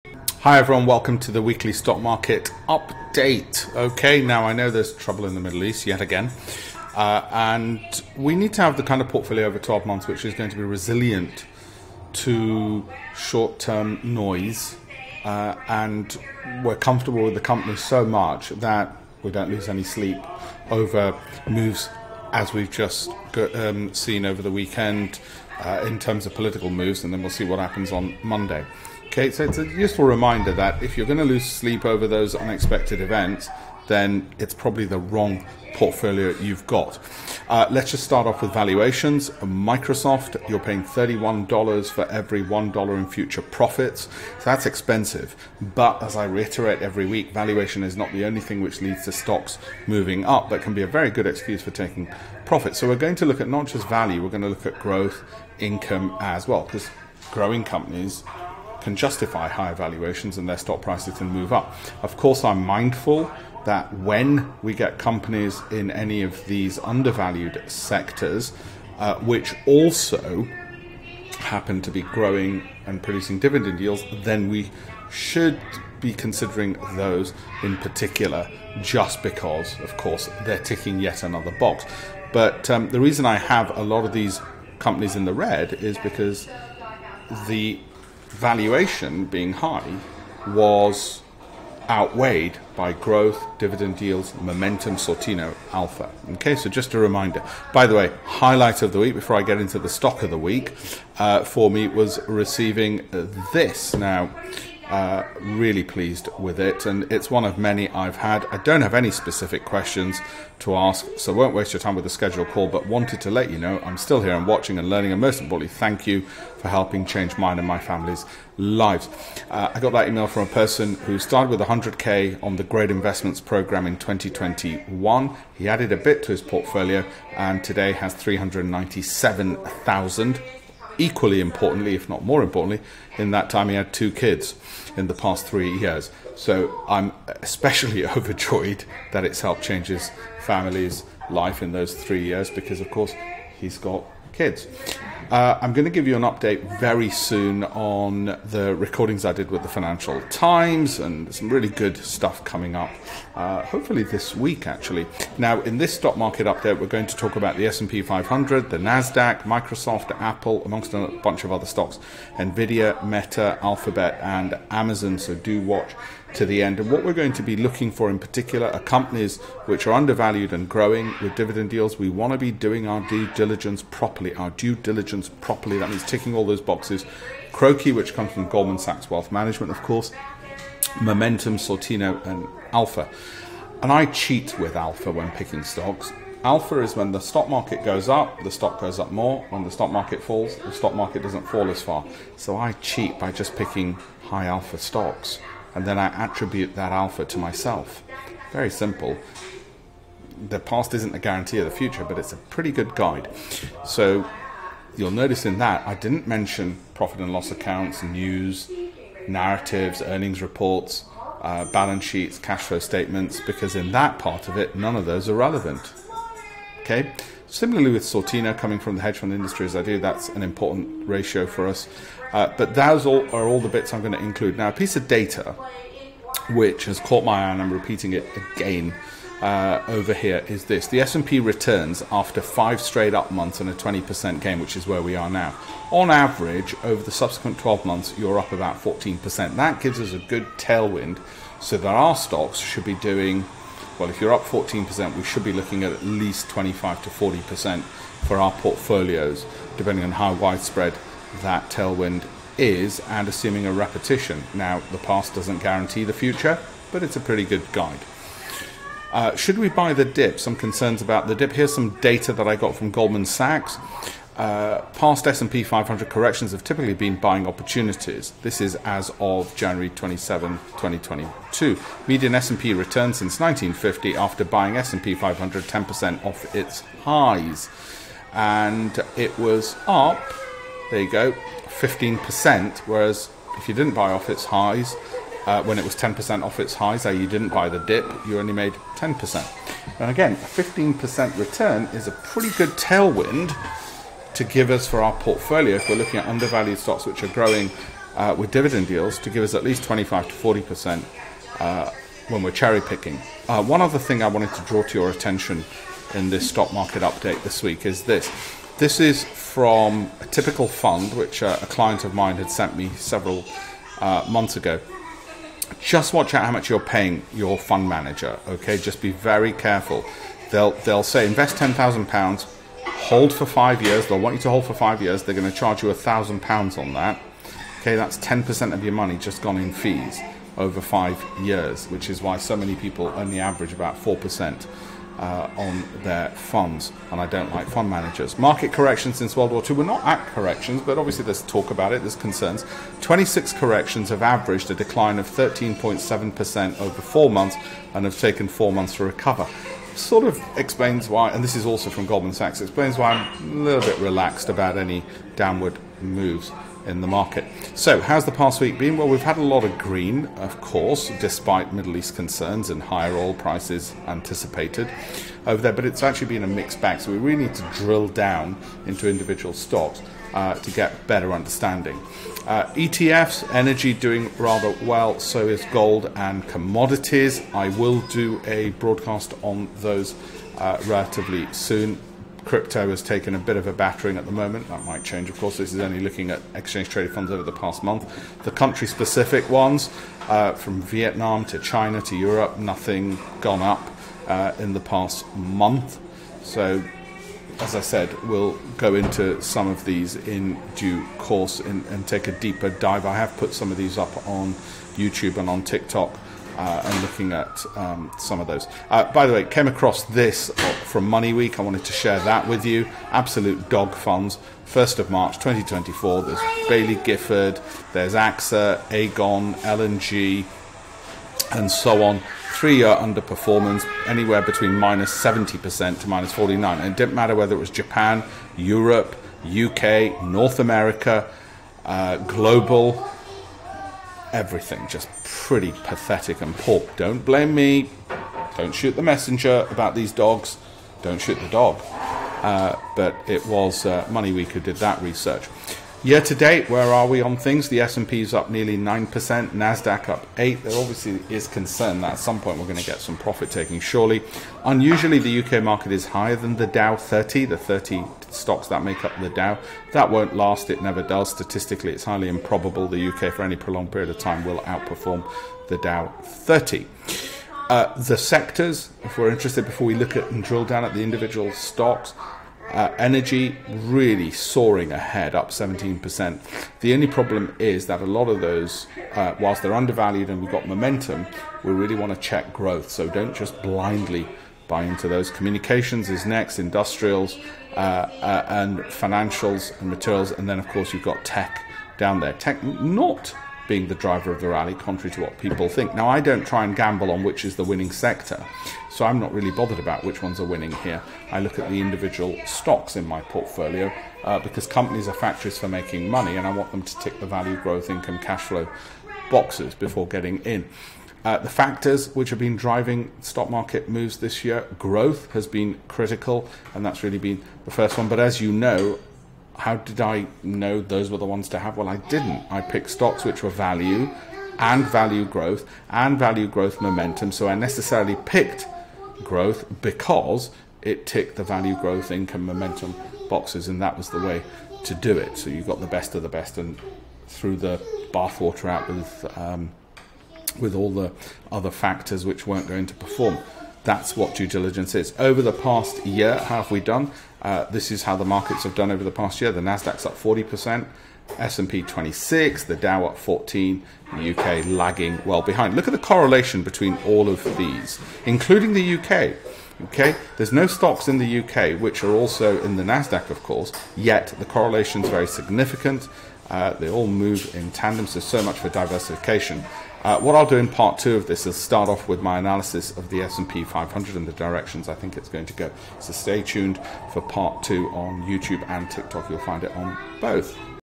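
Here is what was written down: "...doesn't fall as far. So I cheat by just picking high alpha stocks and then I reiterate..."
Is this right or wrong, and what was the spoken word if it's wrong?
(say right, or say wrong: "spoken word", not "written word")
wrong: "attribute", not "reiterate".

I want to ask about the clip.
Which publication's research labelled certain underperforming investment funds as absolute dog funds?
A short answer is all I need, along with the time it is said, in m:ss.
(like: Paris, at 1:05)
Money Week, at 6:51.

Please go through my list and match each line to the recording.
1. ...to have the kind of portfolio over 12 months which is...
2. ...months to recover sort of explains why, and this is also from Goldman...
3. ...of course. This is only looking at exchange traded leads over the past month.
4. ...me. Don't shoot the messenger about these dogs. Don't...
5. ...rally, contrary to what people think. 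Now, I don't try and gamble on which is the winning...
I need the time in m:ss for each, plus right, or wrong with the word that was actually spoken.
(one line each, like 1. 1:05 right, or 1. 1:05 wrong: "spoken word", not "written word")
1. 0:08 right
2. 5:48 right
3. 6:25 wrong: "funds", not "leads"
4. 7:17 right
5. 8:14 right.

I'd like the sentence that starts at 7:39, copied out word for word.
That won't last, it never does.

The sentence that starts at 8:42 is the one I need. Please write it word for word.
I picked stocks which were value and value growth and value growth momentum.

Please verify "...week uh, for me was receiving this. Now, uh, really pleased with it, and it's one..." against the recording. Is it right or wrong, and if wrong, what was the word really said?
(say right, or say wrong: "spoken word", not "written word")
right.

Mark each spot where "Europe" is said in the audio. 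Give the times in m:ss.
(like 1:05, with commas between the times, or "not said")
6:32, 7:08.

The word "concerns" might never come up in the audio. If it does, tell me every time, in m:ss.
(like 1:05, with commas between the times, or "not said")
4:20, 5:42, 6:02, 7:31.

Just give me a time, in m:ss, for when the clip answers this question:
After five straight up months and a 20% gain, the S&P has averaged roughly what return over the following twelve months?
3:58.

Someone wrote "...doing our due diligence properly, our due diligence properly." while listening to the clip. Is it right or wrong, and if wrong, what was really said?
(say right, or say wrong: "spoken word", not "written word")
right.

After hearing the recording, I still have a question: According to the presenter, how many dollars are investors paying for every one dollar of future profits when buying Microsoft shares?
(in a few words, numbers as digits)
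$31.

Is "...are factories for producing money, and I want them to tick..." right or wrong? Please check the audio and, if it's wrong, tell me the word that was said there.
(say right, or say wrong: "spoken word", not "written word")
wrong: "making", not "producing".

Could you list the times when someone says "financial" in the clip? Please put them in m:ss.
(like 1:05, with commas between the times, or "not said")
2:29, 8:08.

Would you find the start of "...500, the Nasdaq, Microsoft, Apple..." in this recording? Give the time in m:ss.
2:38.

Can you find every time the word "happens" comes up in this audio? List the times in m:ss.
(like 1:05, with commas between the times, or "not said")
0:27, 1:11.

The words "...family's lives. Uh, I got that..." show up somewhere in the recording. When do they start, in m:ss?
1:57.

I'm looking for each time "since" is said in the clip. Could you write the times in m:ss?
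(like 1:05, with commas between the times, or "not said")
4:33, 5:39.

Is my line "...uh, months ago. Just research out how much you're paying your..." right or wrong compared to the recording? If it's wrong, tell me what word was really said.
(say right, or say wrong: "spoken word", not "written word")
wrong: "watch", not "research".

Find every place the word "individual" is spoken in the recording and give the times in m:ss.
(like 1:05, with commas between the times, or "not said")
6:09, 7:51, 8:21.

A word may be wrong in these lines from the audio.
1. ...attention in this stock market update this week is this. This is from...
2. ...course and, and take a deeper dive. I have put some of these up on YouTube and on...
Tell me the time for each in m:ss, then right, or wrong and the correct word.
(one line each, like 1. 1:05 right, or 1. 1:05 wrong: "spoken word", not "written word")
1. 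5:05 right
2. 6:41 right.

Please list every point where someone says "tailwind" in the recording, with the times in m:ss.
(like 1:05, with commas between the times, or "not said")
4:00, 4:11, 4:52.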